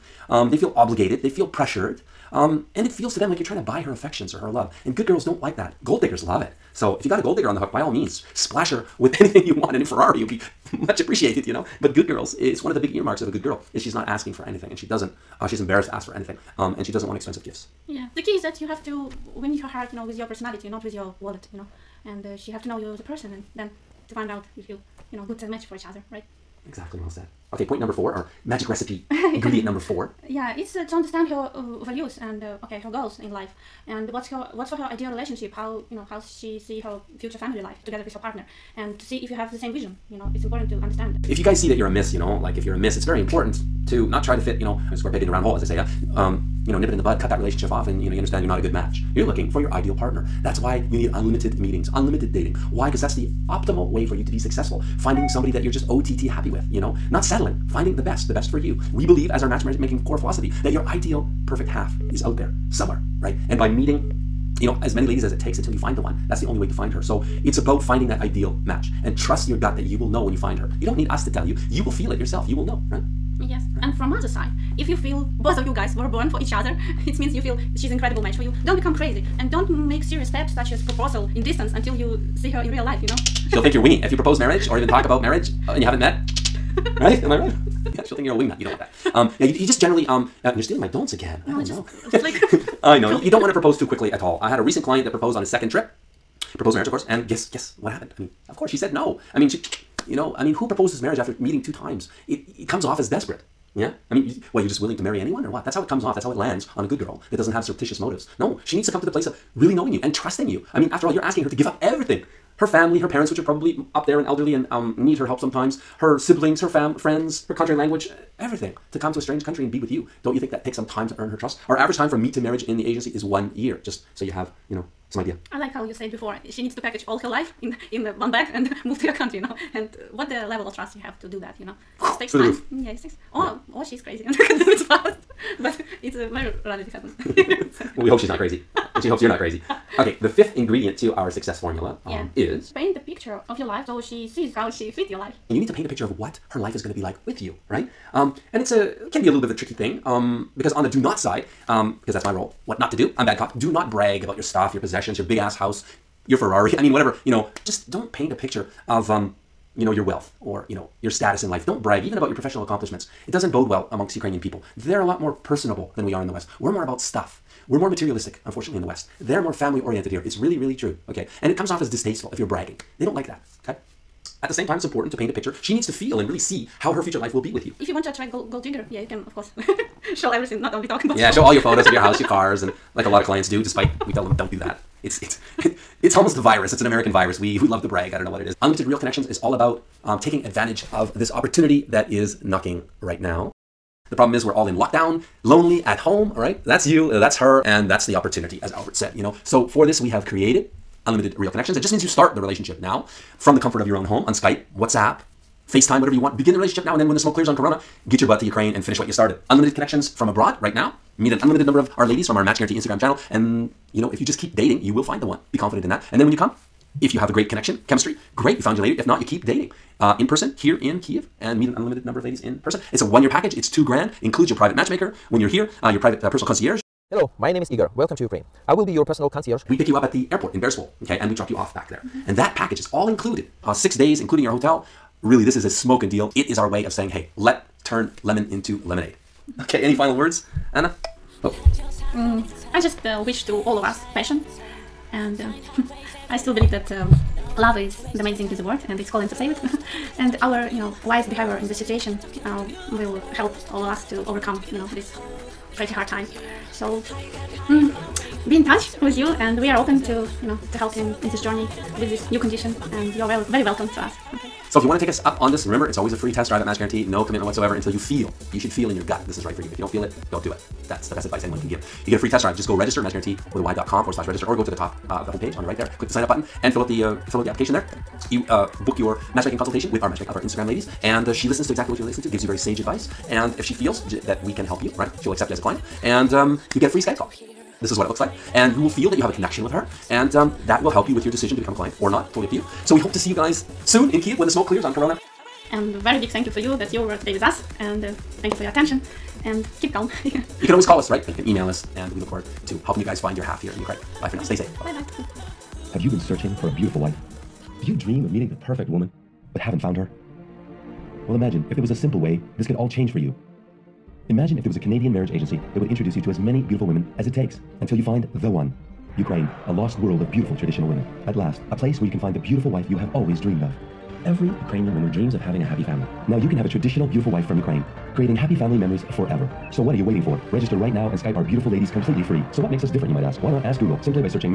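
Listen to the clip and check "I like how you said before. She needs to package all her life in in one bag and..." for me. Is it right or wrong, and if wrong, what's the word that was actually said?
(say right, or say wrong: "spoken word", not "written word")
right.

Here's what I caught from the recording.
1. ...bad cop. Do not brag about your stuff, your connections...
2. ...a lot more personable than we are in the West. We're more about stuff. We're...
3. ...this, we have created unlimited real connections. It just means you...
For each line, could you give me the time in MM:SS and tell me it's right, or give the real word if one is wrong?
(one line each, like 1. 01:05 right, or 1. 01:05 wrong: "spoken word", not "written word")
1. 02:33 wrong: "possessions", not "connections"
2. 02:45 right
3. 03:19 right.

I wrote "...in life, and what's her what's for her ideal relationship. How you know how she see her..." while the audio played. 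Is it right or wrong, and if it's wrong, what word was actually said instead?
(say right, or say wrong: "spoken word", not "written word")
right.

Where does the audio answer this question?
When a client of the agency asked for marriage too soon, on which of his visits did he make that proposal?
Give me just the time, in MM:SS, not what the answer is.
01:35.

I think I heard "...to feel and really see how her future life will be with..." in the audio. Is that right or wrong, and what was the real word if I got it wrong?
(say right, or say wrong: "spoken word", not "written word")
right.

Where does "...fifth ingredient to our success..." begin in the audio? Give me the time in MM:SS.
02:20.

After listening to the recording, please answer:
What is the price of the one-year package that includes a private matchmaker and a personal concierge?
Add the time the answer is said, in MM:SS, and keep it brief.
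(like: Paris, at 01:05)
2 grand, at 03:43.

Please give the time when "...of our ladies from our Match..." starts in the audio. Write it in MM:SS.
03:31.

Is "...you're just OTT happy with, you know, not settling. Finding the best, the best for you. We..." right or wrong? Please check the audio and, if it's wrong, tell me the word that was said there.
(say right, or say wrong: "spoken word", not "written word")
right.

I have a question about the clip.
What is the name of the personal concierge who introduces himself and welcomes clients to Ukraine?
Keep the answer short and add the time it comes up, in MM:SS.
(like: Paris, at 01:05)
Igor, at 03:47.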